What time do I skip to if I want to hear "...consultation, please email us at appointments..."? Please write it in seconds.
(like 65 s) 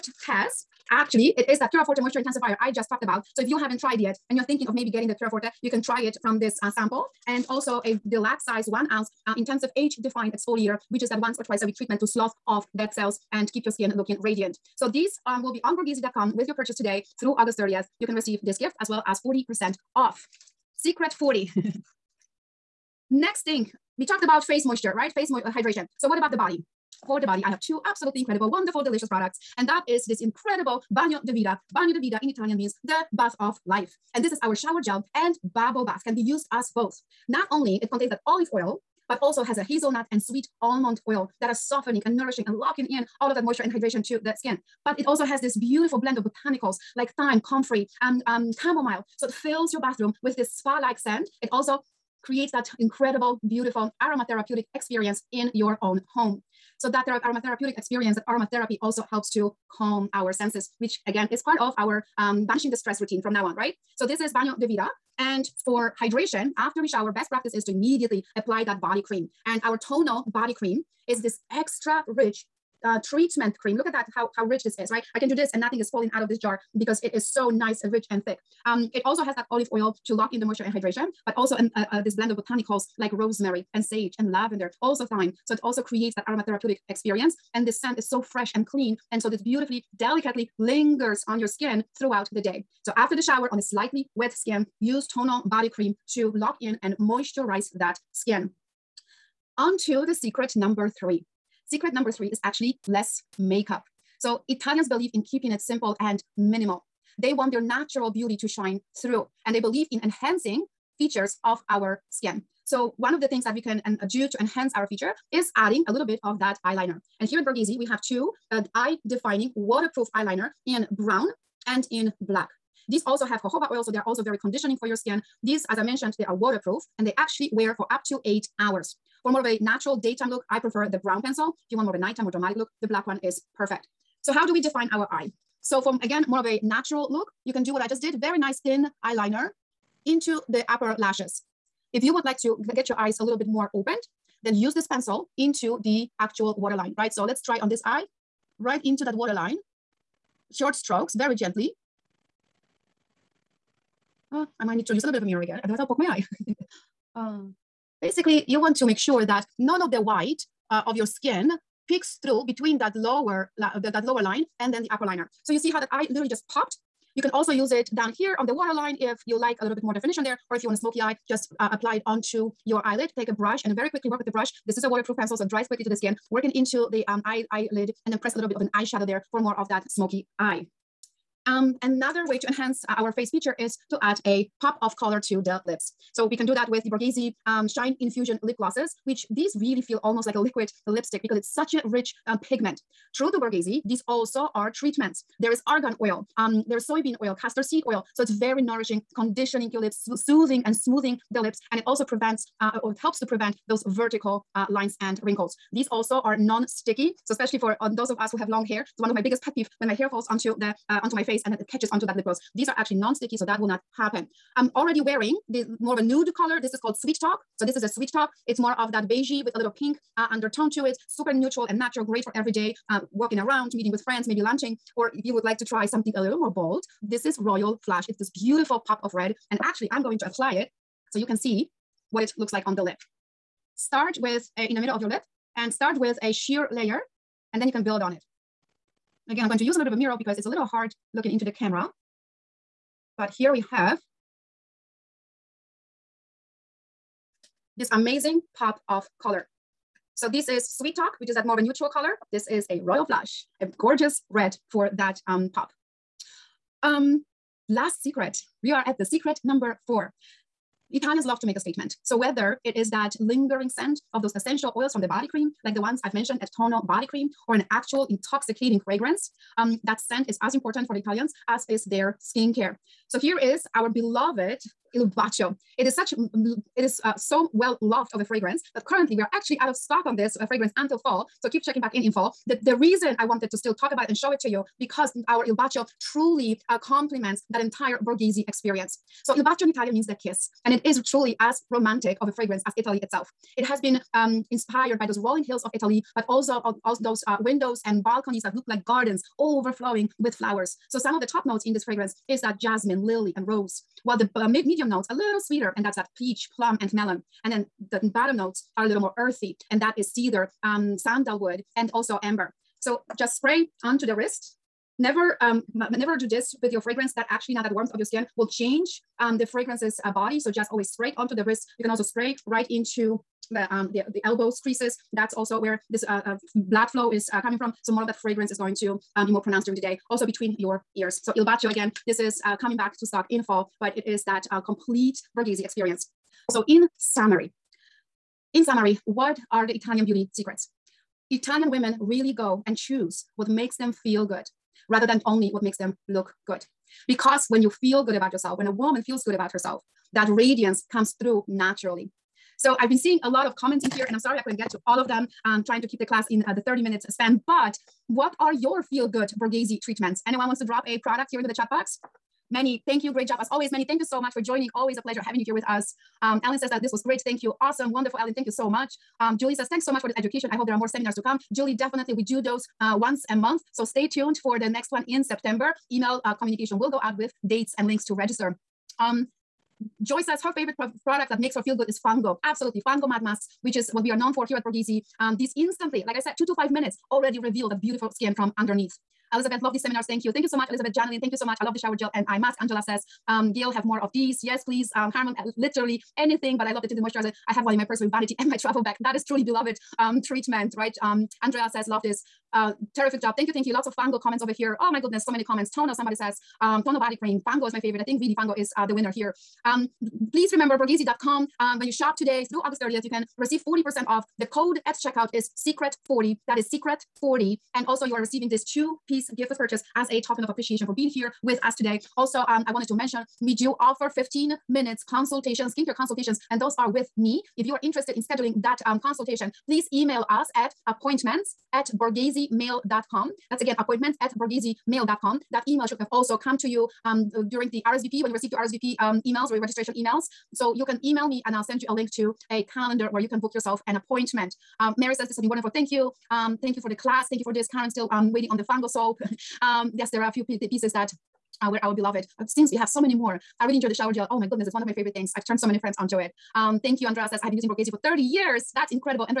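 428 s.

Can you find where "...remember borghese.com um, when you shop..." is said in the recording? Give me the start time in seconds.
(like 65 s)
410 s.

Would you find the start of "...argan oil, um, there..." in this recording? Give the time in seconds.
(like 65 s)
195 s.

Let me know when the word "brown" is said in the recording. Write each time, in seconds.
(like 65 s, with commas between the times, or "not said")
120 s, 131 s.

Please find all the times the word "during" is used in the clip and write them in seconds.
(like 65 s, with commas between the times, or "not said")
329 s, 437 s.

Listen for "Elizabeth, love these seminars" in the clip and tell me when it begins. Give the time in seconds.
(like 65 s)
389 s.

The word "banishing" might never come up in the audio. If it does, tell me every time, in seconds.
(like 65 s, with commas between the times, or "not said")
62 s.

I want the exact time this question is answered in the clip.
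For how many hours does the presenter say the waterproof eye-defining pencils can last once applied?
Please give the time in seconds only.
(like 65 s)
128 s.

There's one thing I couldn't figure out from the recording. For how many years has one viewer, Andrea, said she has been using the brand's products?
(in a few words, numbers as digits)
30.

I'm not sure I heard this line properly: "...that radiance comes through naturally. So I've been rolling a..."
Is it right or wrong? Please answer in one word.
wrong.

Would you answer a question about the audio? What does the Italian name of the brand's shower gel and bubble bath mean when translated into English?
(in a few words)
the bath of life.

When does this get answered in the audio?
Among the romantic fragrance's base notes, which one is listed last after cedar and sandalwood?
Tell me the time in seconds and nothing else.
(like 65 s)
312 s.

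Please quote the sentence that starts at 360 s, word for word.
Anyone wants to drop a product here into the chat box?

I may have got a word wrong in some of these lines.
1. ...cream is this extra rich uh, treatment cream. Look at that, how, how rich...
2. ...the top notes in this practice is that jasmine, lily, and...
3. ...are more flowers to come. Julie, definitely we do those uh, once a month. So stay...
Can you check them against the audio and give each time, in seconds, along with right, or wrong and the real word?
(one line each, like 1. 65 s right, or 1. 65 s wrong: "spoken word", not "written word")
1. 70 s right
2. 301 s wrong: "fragrance", not "practice"
3. 370 s wrong: "seminars", not "flowers".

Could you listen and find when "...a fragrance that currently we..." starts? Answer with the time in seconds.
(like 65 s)
278 s.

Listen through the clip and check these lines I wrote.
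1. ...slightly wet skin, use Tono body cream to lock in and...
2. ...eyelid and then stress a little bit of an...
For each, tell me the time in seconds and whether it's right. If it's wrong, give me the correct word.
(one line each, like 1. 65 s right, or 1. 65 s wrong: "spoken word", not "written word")
1. 93 s right
2. 177 s wrong: "press", not "stress".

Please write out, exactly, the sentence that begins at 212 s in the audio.
These are actually non-sticky, so that will not happen.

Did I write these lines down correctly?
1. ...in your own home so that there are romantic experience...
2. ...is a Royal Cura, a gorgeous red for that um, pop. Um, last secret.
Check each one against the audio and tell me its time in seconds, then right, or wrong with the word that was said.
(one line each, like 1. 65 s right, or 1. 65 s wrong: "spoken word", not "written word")
1. 55 s wrong: "aromatherapeutic", not "romantic"
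2. 252 s wrong: "Flush", not "Cura".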